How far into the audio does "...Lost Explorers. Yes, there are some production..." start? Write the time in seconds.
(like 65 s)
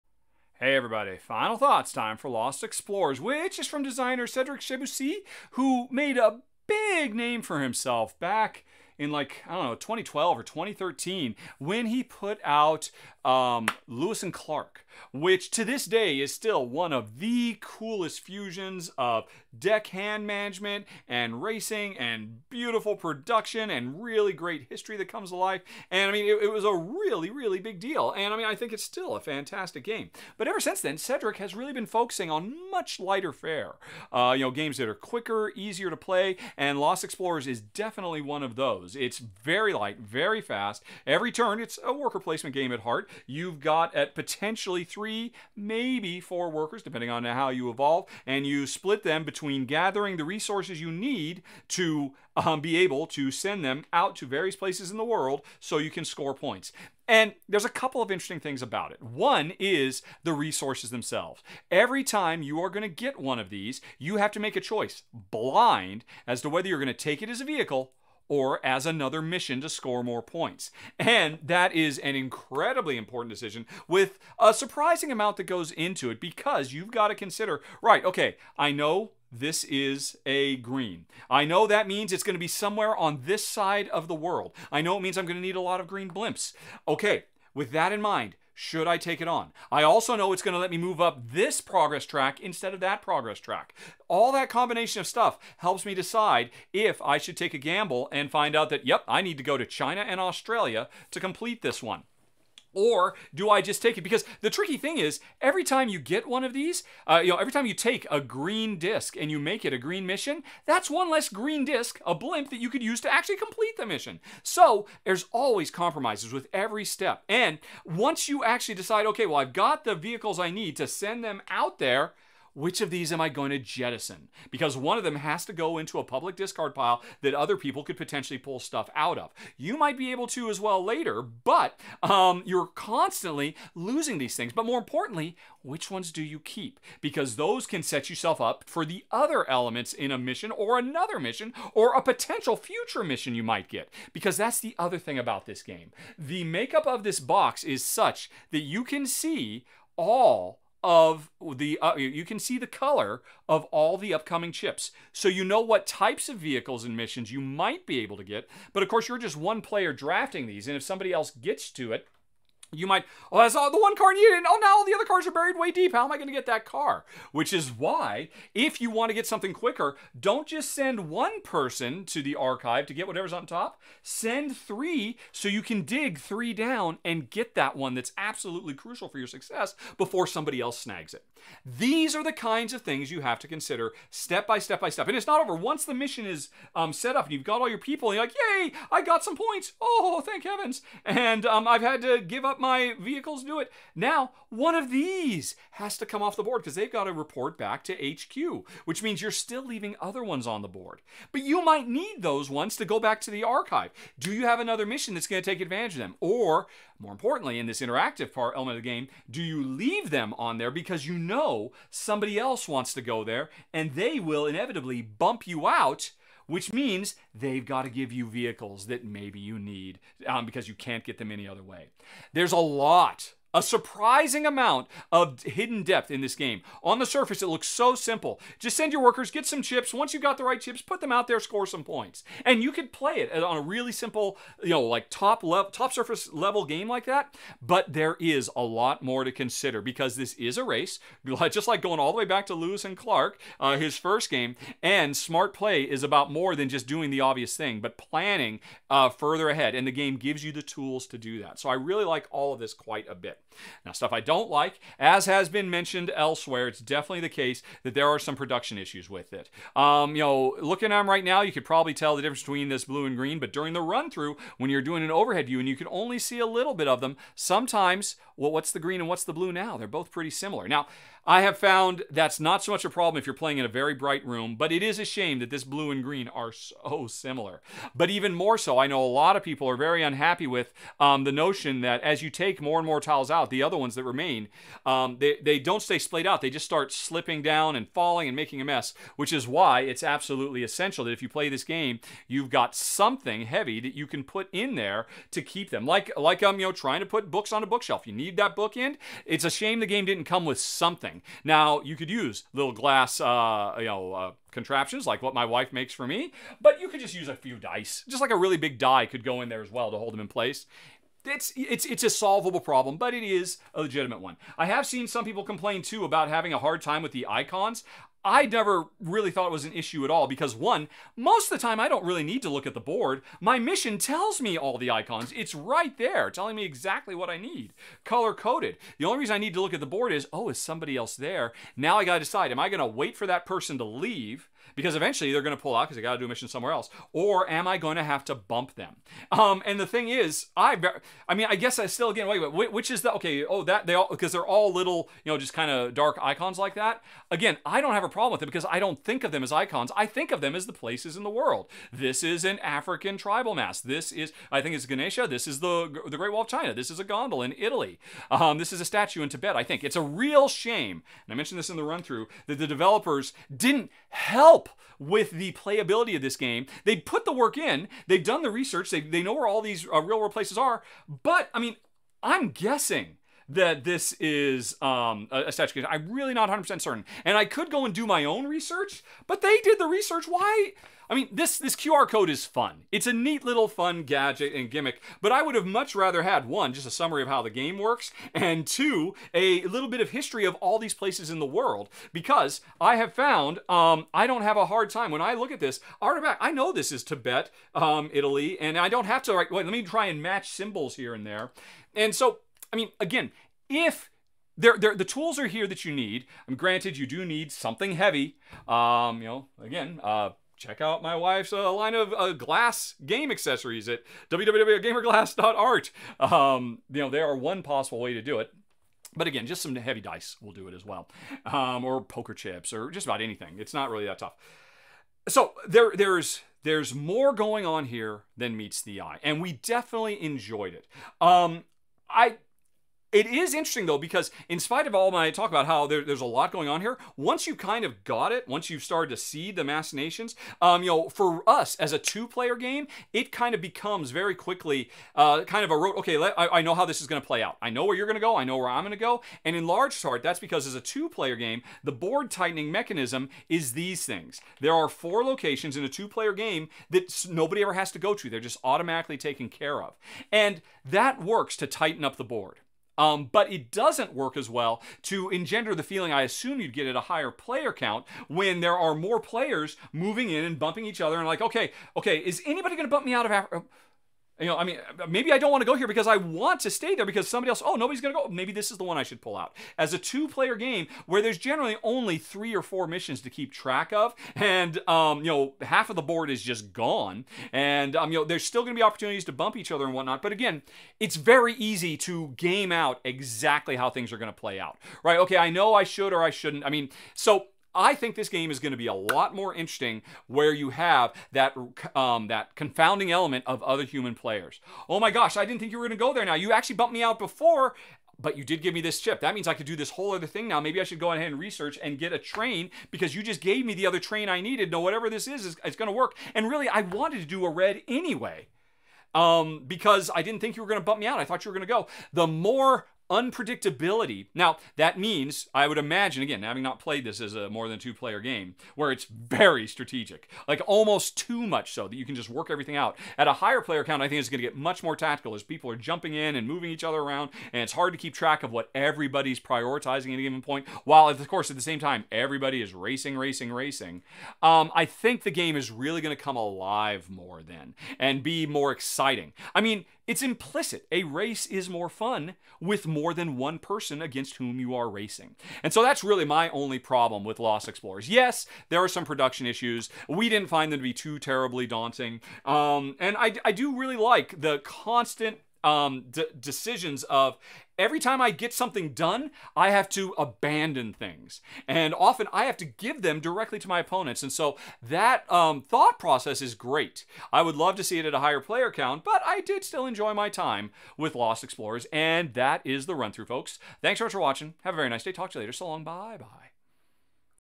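557 s.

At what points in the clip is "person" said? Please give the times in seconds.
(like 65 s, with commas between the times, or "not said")
171 s, 333 s, 553 s.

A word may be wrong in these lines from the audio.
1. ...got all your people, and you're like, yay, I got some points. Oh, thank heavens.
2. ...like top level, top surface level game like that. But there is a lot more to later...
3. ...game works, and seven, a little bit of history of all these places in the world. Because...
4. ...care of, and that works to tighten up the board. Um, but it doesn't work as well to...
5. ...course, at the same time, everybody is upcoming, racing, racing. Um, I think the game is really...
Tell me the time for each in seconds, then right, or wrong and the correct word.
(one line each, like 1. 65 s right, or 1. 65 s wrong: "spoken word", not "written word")
1. 187 s right
2. 234 s wrong: "consider", not "later"
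3. 387 s wrong: "two", not "seven"
4. 459 s right
5. 541 s wrong: "racing", not "upcoming".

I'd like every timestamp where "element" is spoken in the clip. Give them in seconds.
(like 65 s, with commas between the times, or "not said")
139 s, 208 s, 503 s.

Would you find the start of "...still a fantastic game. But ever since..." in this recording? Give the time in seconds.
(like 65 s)
28 s.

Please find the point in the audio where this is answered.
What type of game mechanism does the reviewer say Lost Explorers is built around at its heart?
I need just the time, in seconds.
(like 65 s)
41 s.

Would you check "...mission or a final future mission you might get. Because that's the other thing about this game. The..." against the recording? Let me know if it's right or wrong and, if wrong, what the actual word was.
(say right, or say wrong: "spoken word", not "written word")
wrong: "potential", not "final".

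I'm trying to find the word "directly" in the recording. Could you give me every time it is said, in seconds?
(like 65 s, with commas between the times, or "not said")
573 s.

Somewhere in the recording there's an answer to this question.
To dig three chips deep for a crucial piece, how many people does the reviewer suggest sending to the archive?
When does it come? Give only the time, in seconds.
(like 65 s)
174 s.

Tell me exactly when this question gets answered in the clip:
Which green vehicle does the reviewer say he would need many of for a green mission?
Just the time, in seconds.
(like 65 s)
85 s.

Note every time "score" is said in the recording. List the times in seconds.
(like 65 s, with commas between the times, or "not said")
56 s, 69 s, 231 s.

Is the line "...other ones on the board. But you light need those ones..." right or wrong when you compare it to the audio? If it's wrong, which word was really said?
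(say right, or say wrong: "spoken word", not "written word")
wrong: "might", not "light".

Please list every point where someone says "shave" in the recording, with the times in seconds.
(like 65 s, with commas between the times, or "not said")
not said.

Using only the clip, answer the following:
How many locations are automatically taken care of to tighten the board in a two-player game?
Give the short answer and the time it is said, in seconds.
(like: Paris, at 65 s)
4, at 454 s.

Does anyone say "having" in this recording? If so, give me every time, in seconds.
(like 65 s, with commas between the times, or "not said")
316 s, 526 s.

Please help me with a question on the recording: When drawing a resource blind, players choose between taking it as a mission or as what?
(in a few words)
a vehicle.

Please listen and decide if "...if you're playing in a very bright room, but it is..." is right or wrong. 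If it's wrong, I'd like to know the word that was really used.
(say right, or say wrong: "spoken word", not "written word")
right.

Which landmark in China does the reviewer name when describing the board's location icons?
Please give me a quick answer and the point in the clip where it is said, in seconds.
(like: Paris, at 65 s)
Great Wall of China, at 356 s.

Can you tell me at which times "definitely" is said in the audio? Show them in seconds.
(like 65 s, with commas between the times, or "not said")
37 s, 256 s, 429 s.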